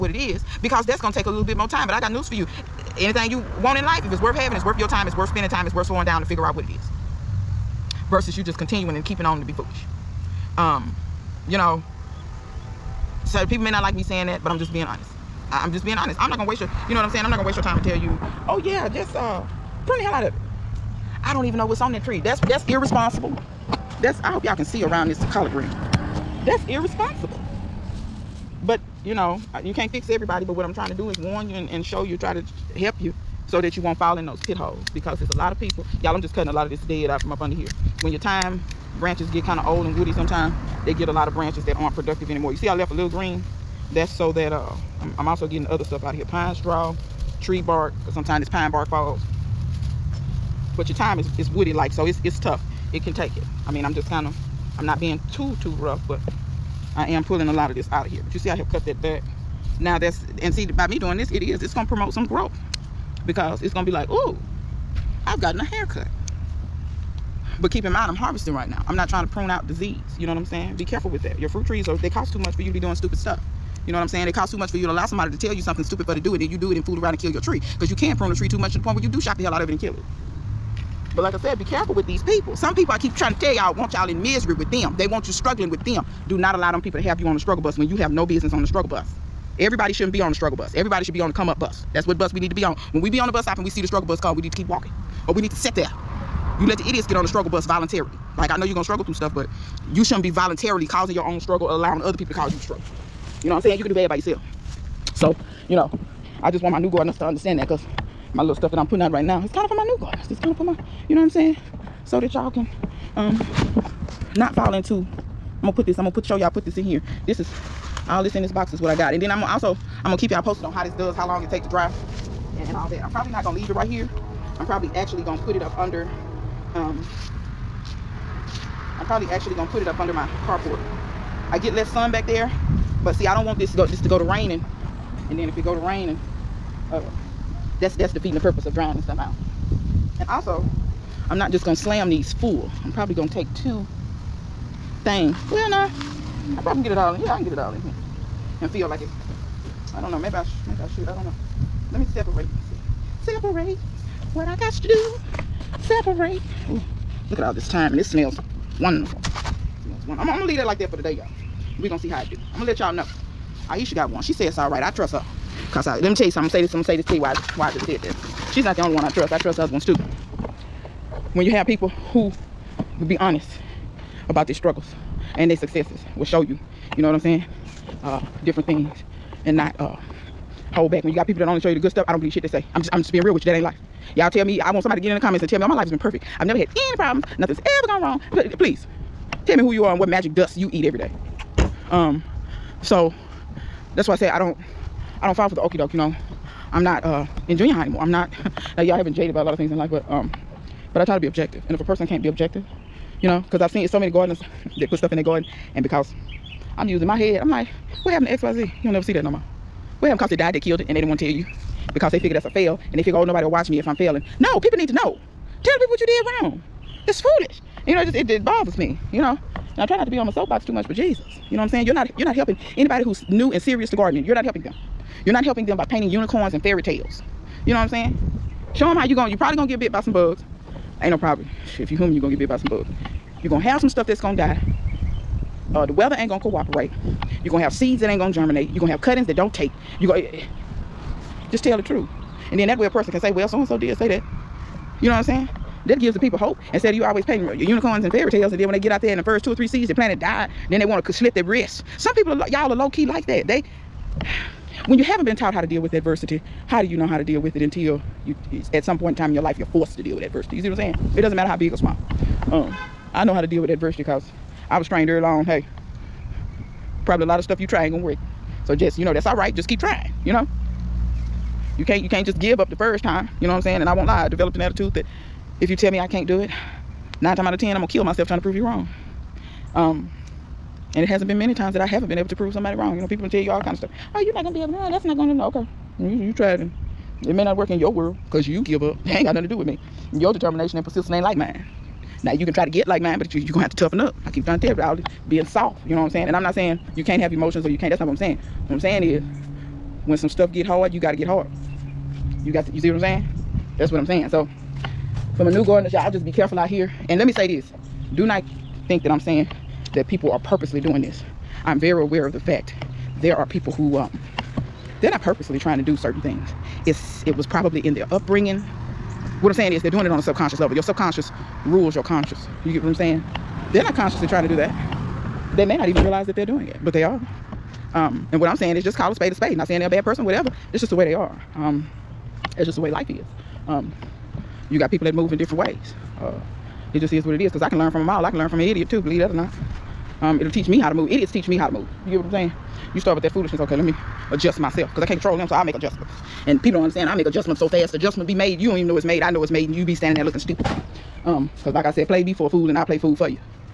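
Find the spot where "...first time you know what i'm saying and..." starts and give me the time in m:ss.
4:32.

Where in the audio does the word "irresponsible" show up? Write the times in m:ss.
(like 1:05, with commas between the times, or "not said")
0:22, 0:26.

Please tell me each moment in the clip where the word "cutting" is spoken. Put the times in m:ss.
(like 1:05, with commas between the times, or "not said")
0:36, 3:59.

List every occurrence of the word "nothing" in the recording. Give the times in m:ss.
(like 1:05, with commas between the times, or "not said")
3:07, 4:49.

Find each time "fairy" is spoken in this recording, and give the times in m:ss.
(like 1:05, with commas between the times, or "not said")
3:46, 4:08.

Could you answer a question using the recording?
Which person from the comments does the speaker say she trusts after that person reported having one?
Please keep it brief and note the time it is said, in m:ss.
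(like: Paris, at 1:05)
Aisha, at 2:43.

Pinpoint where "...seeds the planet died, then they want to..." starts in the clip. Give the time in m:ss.
4:09.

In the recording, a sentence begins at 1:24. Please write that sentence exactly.
They want you struggling with them.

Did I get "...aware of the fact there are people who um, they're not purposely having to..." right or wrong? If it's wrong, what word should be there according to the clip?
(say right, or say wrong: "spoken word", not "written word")
wrong: "trying", not "having".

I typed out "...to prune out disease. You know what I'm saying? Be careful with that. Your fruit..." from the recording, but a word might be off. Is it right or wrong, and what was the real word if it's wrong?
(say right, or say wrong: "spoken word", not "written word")
right.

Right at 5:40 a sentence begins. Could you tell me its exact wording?
Um, it'll teach me how to move.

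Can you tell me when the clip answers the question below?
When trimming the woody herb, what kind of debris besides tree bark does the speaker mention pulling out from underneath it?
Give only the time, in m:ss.
0:46.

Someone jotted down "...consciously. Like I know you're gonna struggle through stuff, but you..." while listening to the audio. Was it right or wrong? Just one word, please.
wrong.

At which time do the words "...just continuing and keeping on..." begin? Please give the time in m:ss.
0:08.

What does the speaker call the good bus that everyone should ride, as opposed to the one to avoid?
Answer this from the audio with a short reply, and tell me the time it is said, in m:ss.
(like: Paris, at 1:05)
Come up bus, at 1:31.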